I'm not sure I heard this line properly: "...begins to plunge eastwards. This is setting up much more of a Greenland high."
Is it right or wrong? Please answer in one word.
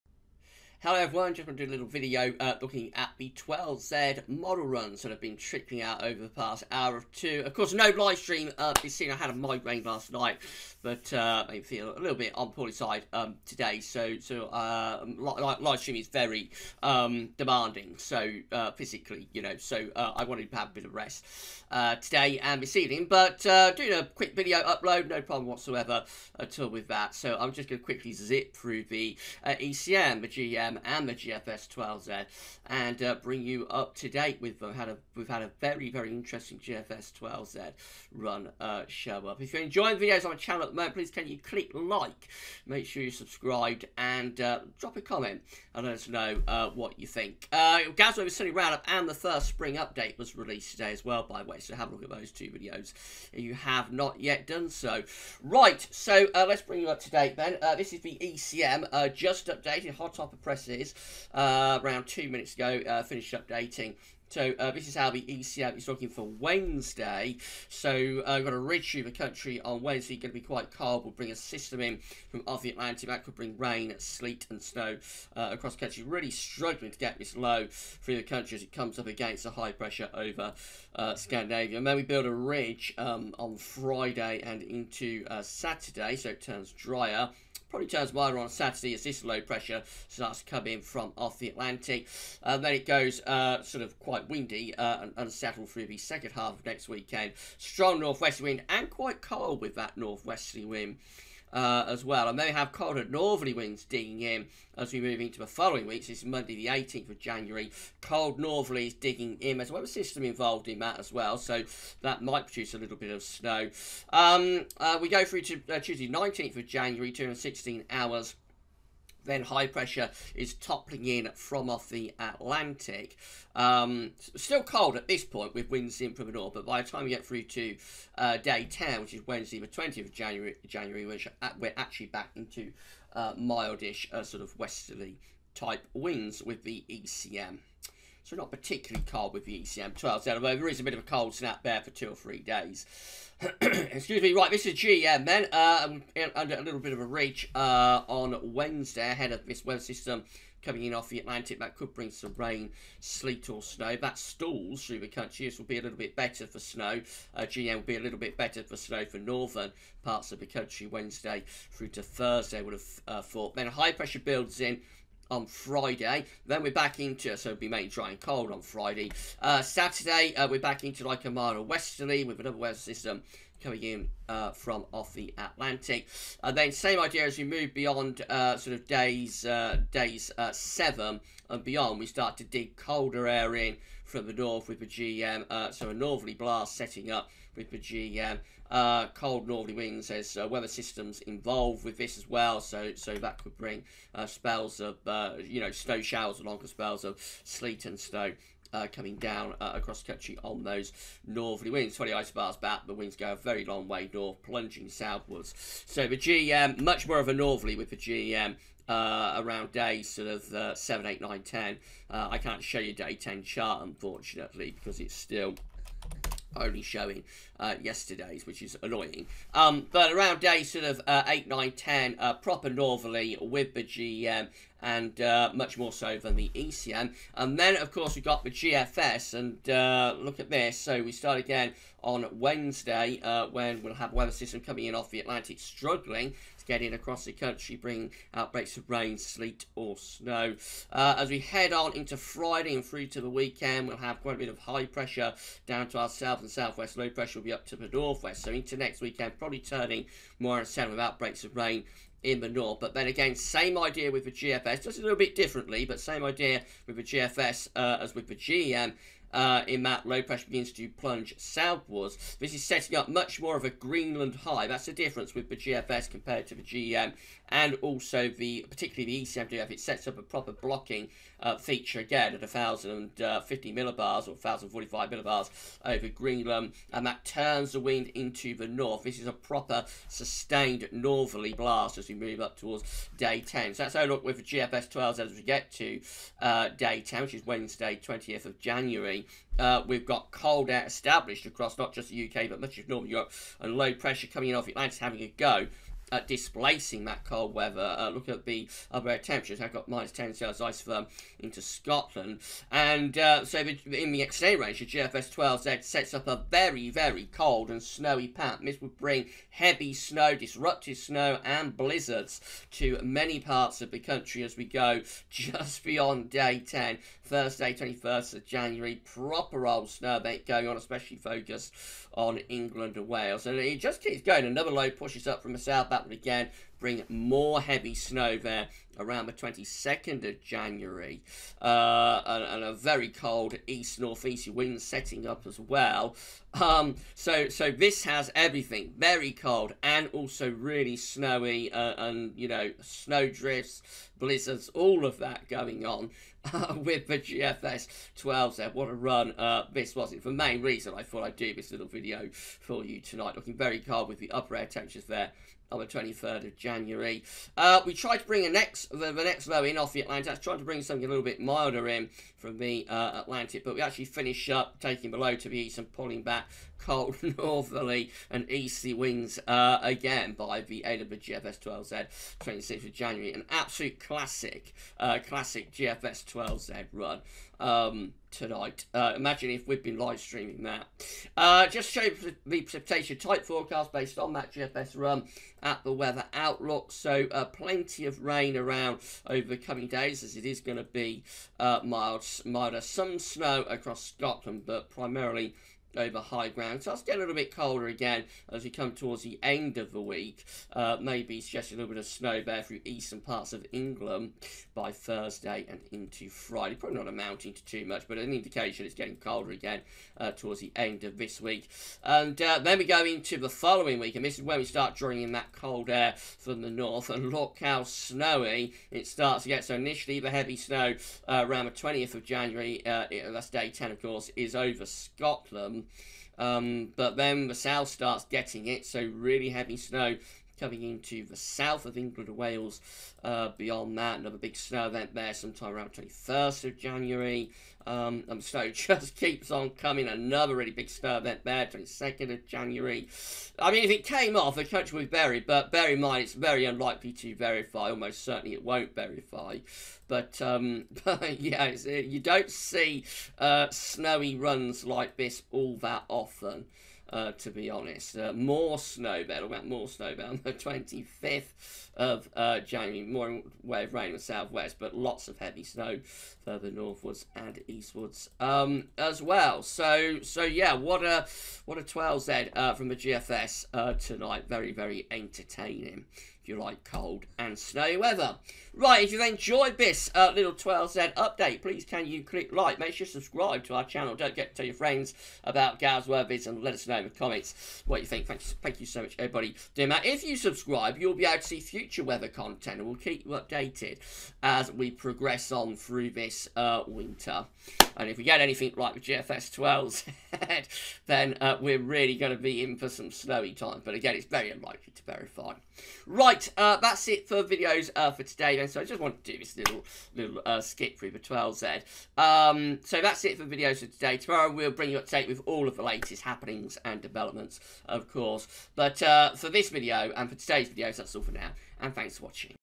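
wrong.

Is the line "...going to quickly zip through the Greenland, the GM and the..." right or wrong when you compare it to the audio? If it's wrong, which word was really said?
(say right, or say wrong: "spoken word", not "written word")
wrong: "ECM", not "Greenland".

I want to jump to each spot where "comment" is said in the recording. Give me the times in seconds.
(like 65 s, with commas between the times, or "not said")
45 s, 487 s.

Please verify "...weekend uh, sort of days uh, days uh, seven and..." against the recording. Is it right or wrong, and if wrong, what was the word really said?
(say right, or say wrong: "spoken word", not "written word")
wrong: "beyond", not "weekend".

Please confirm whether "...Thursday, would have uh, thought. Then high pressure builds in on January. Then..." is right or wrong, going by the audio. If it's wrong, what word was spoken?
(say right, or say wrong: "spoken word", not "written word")
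wrong: "Friday", not "January".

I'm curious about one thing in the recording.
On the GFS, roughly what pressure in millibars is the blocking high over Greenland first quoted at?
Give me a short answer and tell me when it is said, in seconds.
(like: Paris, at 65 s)
1,050 millibars, at 272 s.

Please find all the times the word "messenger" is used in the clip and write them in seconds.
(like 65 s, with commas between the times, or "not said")
not said.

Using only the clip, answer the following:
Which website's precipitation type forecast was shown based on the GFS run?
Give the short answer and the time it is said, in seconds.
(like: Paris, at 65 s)
The Weather Outlook, at 385 s.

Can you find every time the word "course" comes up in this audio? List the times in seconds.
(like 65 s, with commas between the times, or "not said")
7 s, 227 s, 424 s, 518 s.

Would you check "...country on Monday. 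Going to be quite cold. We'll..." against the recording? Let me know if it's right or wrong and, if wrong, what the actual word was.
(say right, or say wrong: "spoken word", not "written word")
wrong: "Wednesday", not "Monday".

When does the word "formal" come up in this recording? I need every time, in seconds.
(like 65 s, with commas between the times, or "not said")
not said.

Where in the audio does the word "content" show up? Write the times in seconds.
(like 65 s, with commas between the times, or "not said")
492 s.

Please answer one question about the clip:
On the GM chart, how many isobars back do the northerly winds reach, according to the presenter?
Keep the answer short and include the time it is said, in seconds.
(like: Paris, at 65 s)
20, at 201 s.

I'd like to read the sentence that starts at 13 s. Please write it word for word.
So, so uh, um, li live stream is very um, demanding, so uh, physically, you know.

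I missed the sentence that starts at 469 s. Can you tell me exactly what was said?
So, so yeah, what a what a 12Z uh, from the GFS uh, tonight.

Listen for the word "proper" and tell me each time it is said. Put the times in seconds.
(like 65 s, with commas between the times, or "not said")
222 s, 270 s, 279 s, 319 s.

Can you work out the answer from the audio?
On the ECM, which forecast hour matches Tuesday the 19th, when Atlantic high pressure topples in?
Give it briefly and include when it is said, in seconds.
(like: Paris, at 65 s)
216 hours, at 117 s.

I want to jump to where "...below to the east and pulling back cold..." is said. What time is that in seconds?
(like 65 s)
365 s.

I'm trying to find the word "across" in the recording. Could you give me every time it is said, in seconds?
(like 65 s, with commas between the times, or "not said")
75 s, 199 s, 236 s, 291 s, 393 s.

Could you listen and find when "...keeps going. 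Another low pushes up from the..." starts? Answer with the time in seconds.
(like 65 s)
324 s.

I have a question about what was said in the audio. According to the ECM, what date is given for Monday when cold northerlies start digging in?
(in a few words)
18th of January.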